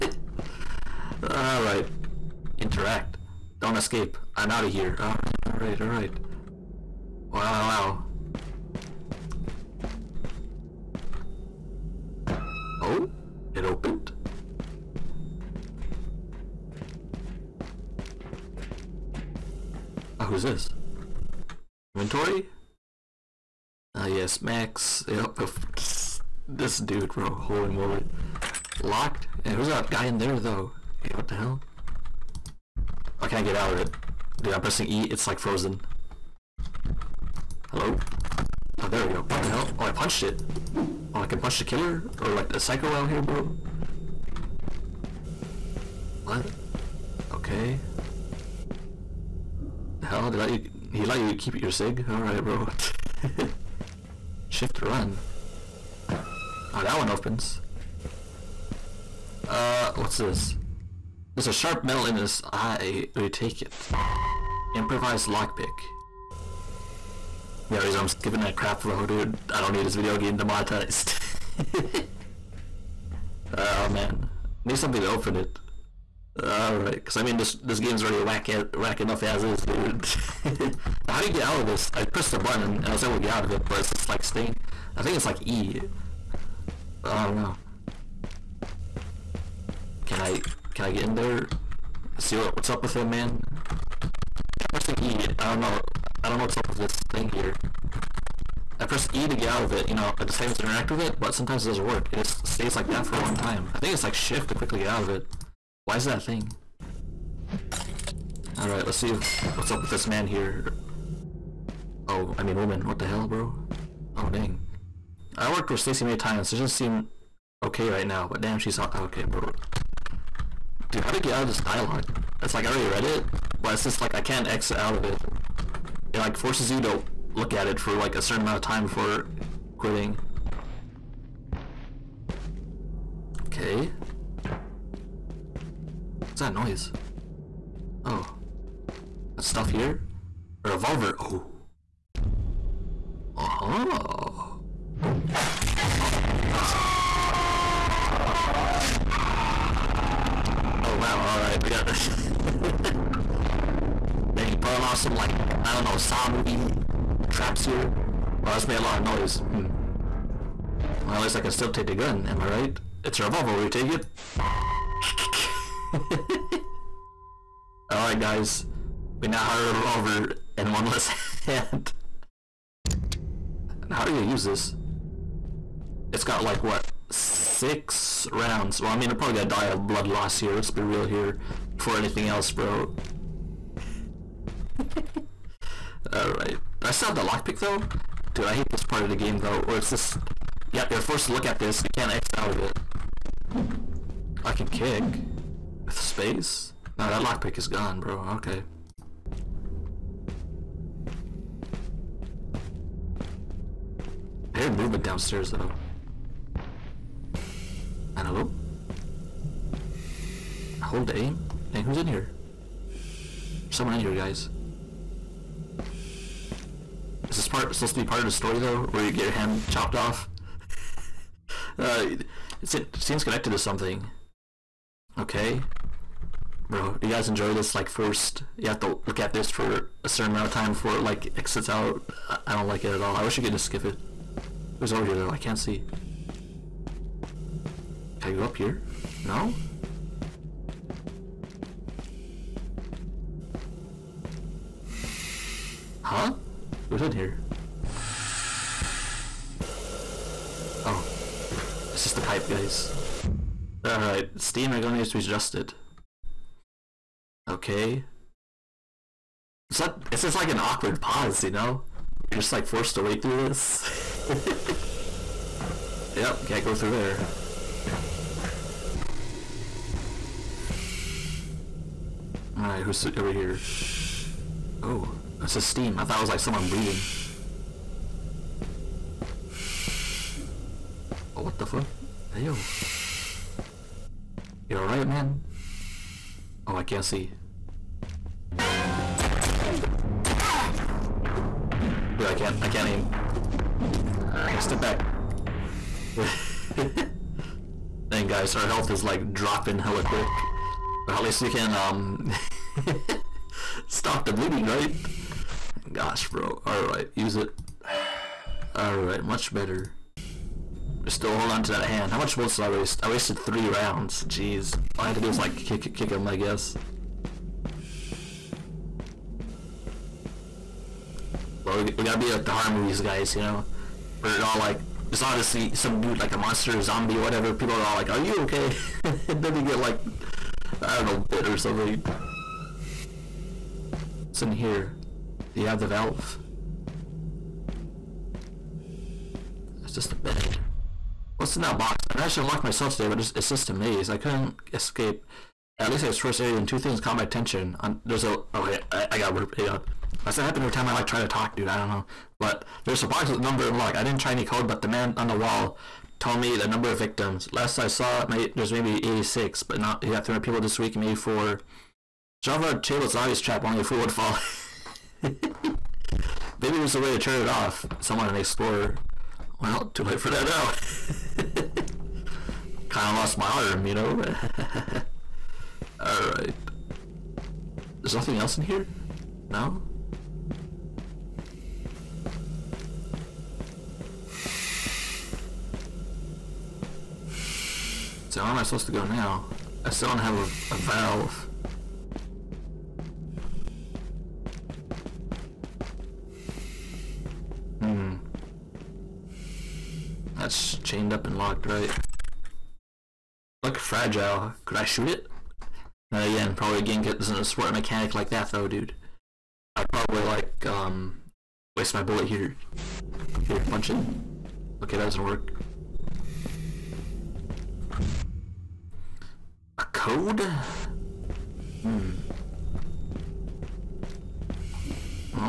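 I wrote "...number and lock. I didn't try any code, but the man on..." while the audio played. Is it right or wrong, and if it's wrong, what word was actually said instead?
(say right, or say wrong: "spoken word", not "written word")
right.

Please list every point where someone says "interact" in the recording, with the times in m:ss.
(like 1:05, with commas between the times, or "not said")
0:02, 1:40.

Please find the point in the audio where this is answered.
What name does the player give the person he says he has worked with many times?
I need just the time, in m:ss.
1:55.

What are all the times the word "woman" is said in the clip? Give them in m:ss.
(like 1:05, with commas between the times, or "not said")
1:52.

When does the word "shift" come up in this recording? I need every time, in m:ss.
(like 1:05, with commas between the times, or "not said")
0:54, 1:44.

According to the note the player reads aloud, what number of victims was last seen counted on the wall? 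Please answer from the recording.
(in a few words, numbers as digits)
86.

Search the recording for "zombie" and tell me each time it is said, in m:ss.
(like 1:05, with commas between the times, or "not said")
5:26.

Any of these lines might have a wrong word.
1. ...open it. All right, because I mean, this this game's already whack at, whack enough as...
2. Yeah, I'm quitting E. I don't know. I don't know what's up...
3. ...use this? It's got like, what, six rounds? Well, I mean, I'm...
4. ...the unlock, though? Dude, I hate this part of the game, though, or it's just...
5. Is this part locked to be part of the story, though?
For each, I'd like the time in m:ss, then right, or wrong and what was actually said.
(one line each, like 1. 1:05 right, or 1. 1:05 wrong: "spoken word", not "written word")
1. 1:15 right
2. 1:34 wrong: "pressing", not "quitting"
3. 2:54 right
4. 3:07 wrong: "lockpick", not "unlock"
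5. 3:37 wrong: "supposed", not "locked".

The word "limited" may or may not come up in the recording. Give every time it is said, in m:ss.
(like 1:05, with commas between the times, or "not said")
not said.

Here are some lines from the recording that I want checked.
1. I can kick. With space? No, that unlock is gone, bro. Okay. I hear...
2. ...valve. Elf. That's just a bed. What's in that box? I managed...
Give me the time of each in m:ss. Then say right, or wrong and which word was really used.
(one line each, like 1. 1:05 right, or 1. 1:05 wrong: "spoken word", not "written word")
1. 3:14 wrong: "lockpick", not "unlock"
2. 5:35 right.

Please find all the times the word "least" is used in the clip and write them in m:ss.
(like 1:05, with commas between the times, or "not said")
2:41, 5:01, 5:45.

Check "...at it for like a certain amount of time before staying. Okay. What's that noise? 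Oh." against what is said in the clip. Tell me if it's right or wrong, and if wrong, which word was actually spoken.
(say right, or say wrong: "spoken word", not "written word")
wrong: "quitting", not "staying".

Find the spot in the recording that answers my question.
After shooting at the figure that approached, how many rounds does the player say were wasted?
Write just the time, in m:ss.
5:13.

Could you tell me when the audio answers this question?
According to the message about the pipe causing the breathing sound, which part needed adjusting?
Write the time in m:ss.
4:14.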